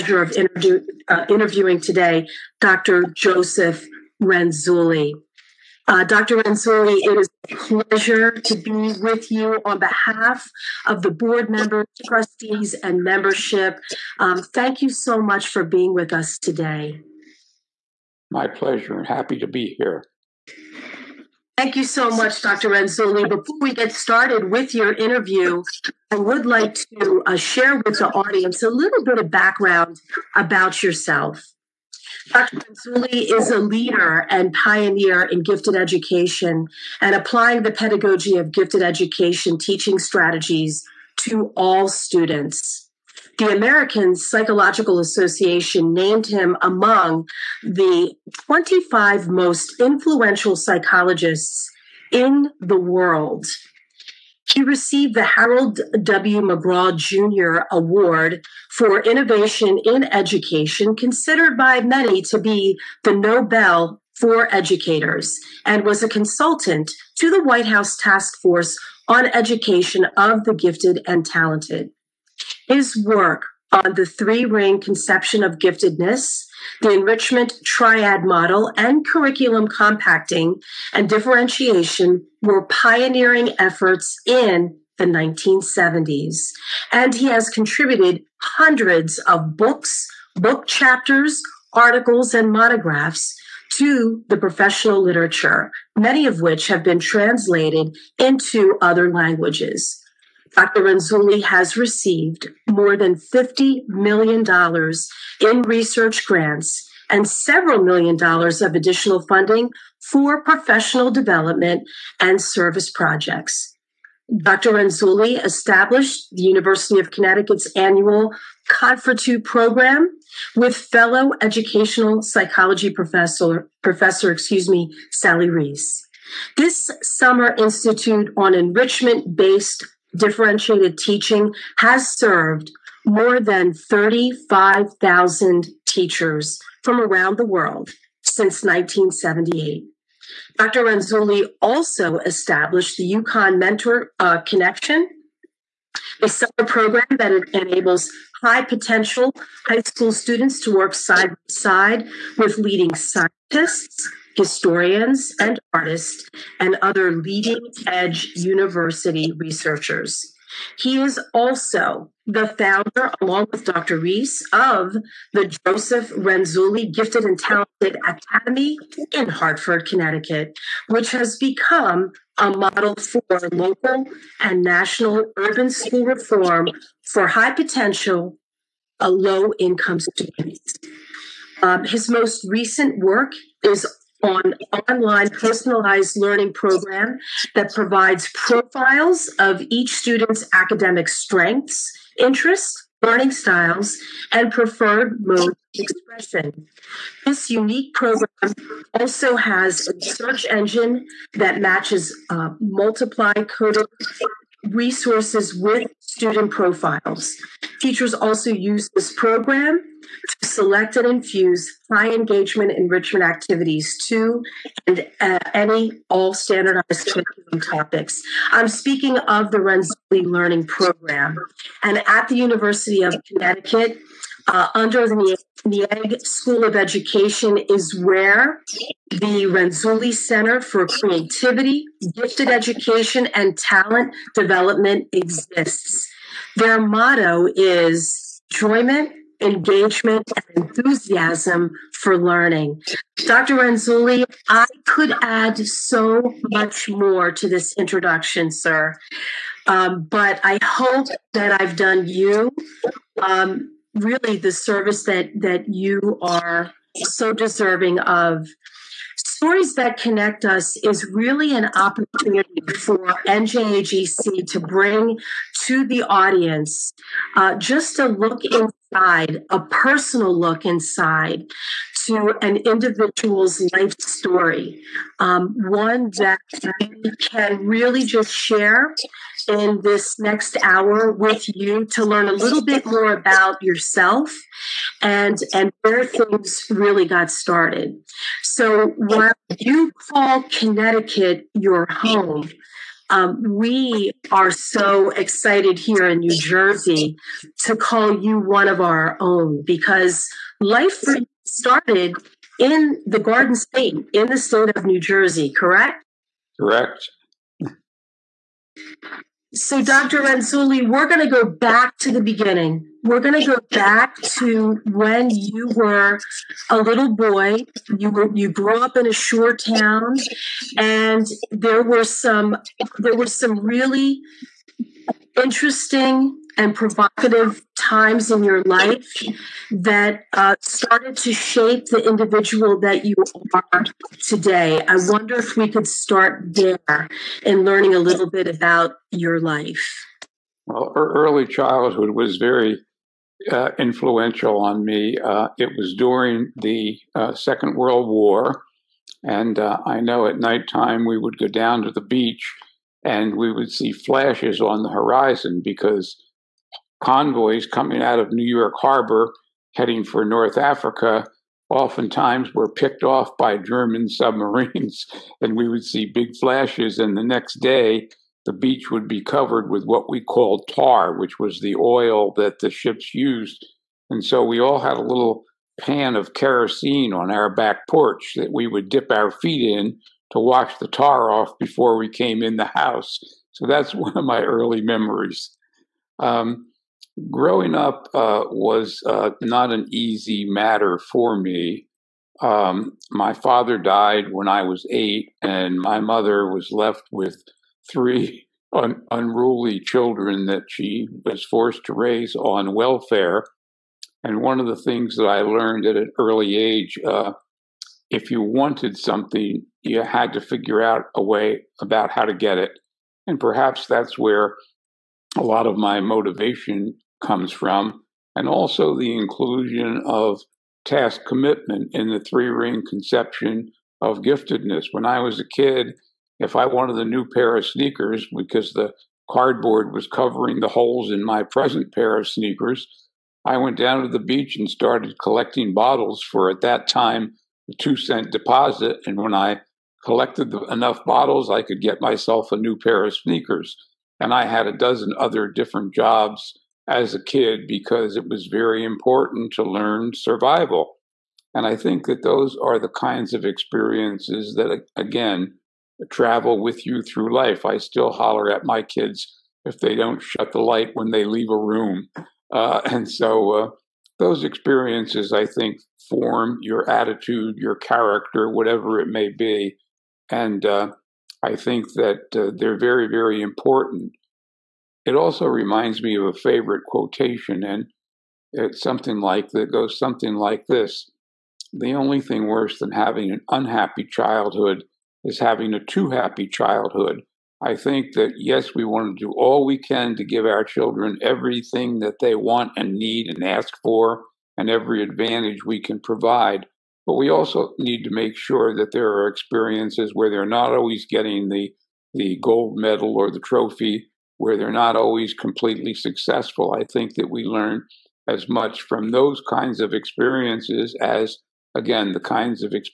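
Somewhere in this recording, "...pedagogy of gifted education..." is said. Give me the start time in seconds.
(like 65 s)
37 s.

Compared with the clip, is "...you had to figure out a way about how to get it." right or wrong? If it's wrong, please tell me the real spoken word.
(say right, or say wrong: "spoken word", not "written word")
right.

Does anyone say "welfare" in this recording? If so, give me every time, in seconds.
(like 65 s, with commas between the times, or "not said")
402 s.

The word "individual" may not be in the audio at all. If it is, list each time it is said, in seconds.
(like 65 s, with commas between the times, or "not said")
272 s, 332 s.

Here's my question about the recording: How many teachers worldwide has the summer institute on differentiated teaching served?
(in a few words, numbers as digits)
35,000.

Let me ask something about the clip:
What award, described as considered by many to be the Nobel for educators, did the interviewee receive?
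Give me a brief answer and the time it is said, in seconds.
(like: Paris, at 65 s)
Harold W. McGraw Jr. Award, at 55 s.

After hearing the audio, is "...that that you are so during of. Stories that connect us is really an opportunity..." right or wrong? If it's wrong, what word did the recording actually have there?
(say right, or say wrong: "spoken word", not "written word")
wrong: "deserving", not "during".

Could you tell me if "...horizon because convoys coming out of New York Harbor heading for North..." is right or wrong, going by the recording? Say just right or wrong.
right.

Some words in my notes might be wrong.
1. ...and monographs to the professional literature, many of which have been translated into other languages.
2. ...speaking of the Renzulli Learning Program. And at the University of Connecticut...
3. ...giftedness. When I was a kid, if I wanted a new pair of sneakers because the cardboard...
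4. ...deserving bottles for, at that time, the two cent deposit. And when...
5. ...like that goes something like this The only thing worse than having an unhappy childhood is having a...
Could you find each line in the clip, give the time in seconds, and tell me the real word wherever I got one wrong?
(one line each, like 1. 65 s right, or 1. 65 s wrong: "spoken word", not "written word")
1. 92 s right
2. 218 s right
3. 424 s right
4. 435 s wrong: "collecting", not "deserving"
5. 479 s right.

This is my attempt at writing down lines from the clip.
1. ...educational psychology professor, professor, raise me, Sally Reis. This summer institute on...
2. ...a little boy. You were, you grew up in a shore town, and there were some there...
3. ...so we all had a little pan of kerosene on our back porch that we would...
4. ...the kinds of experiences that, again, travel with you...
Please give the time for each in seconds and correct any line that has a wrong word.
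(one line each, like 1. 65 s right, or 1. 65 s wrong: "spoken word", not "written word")
1. 121 s wrong: "excuse", not "raise"
2. 316 s right
3. 374 s right
4. 452 s right.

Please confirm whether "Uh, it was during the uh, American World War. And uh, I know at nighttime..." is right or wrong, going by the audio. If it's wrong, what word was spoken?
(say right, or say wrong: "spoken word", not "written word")
wrong: "Second", not "American".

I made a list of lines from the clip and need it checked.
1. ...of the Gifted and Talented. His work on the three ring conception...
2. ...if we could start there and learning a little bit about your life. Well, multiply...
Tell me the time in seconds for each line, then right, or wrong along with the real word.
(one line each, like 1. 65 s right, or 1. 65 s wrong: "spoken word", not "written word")
1. 70 s right
2. 335 s wrong: "early", not "multiply".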